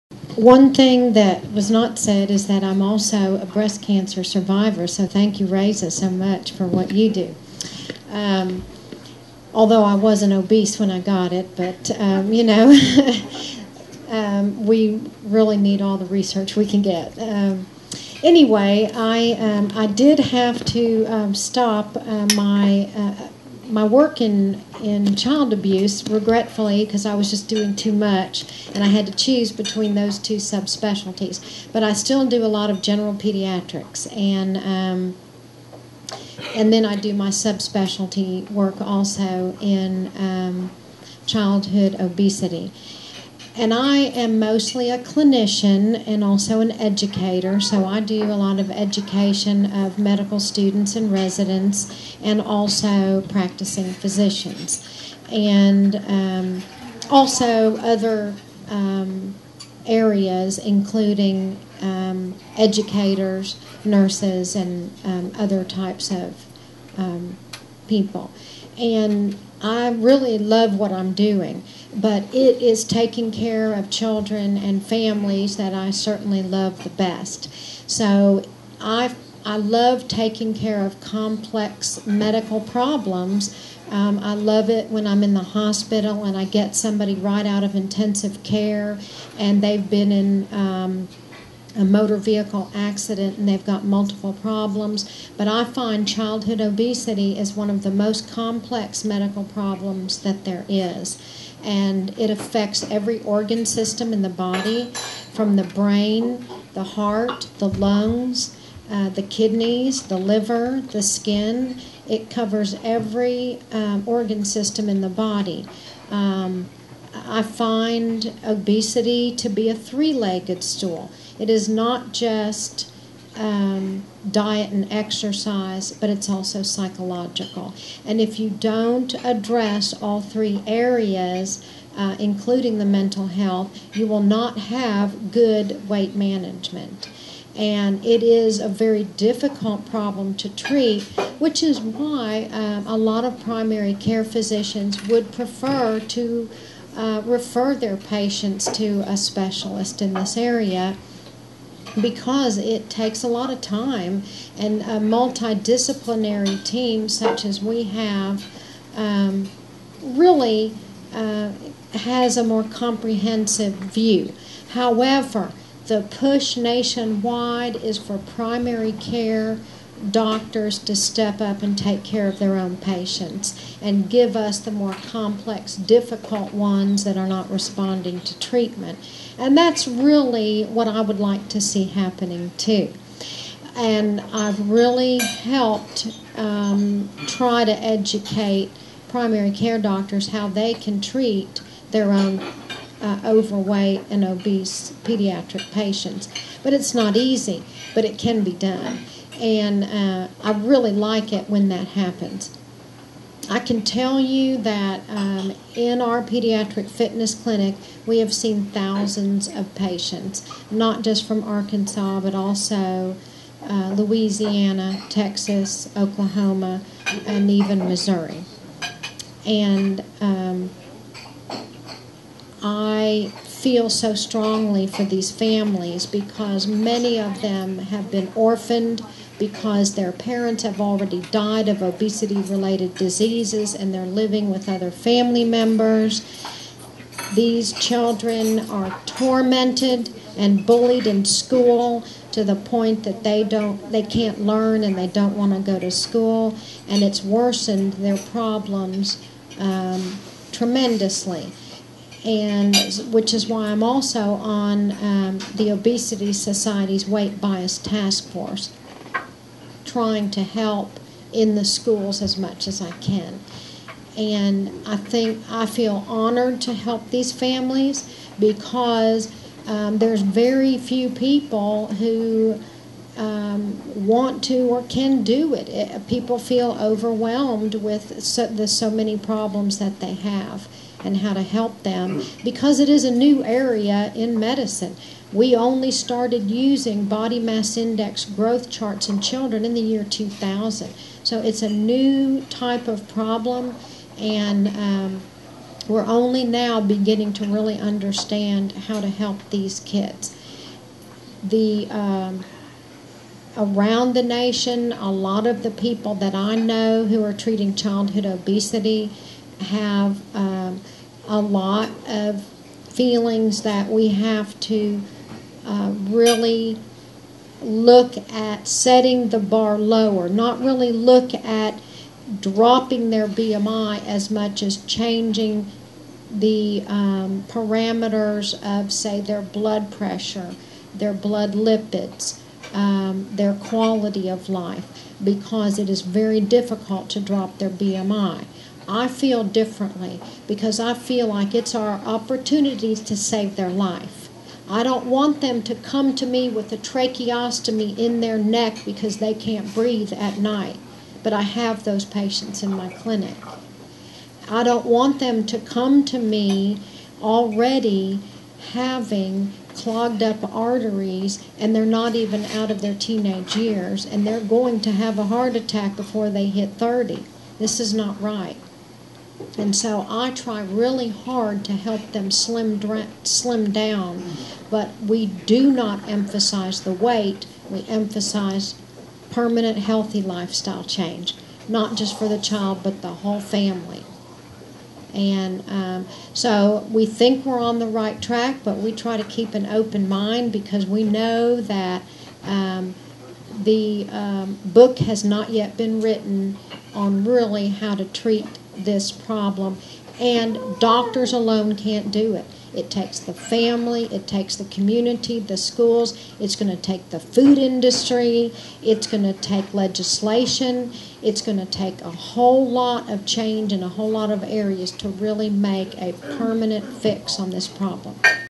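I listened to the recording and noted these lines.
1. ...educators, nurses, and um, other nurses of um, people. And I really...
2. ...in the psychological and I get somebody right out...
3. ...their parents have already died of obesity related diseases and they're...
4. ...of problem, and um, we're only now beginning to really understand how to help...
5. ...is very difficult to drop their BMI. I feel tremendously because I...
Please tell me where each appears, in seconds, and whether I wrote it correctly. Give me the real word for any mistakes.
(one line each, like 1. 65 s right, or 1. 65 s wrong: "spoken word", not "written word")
1. 62 s wrong: "types", not "nurses"
2. 85 s wrong: "hospital", not "psychological"
3. 229 s right
4. 292 s right
5. 335 s wrong: "differently", not "tremendously".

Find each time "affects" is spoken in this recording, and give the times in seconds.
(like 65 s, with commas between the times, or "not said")
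102 s.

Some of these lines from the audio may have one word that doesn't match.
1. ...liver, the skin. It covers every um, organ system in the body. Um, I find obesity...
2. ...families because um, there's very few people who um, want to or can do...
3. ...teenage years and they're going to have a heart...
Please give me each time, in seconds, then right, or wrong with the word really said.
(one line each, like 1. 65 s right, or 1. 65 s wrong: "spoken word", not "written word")
1. 110 s right
2. 267 s right
3. 362 s right.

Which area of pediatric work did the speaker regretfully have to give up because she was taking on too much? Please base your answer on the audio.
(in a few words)
Child abuse.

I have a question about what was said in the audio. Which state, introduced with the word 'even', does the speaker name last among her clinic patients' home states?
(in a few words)
Missouri.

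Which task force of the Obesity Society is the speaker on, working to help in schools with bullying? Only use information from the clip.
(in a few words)
Weight Bias Task Force.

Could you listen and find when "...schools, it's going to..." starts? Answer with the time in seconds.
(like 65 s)
405 s.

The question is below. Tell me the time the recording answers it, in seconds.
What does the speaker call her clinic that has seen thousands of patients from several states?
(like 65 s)
206 s.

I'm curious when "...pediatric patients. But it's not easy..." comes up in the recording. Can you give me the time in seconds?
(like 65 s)
195 s.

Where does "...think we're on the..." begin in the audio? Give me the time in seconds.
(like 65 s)
387 s.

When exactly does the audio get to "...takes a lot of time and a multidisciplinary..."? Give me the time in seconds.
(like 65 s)
152 s.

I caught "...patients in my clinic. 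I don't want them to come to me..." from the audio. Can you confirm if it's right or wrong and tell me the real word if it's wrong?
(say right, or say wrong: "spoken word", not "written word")
right.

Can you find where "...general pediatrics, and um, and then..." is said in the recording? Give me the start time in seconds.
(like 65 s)
32 s.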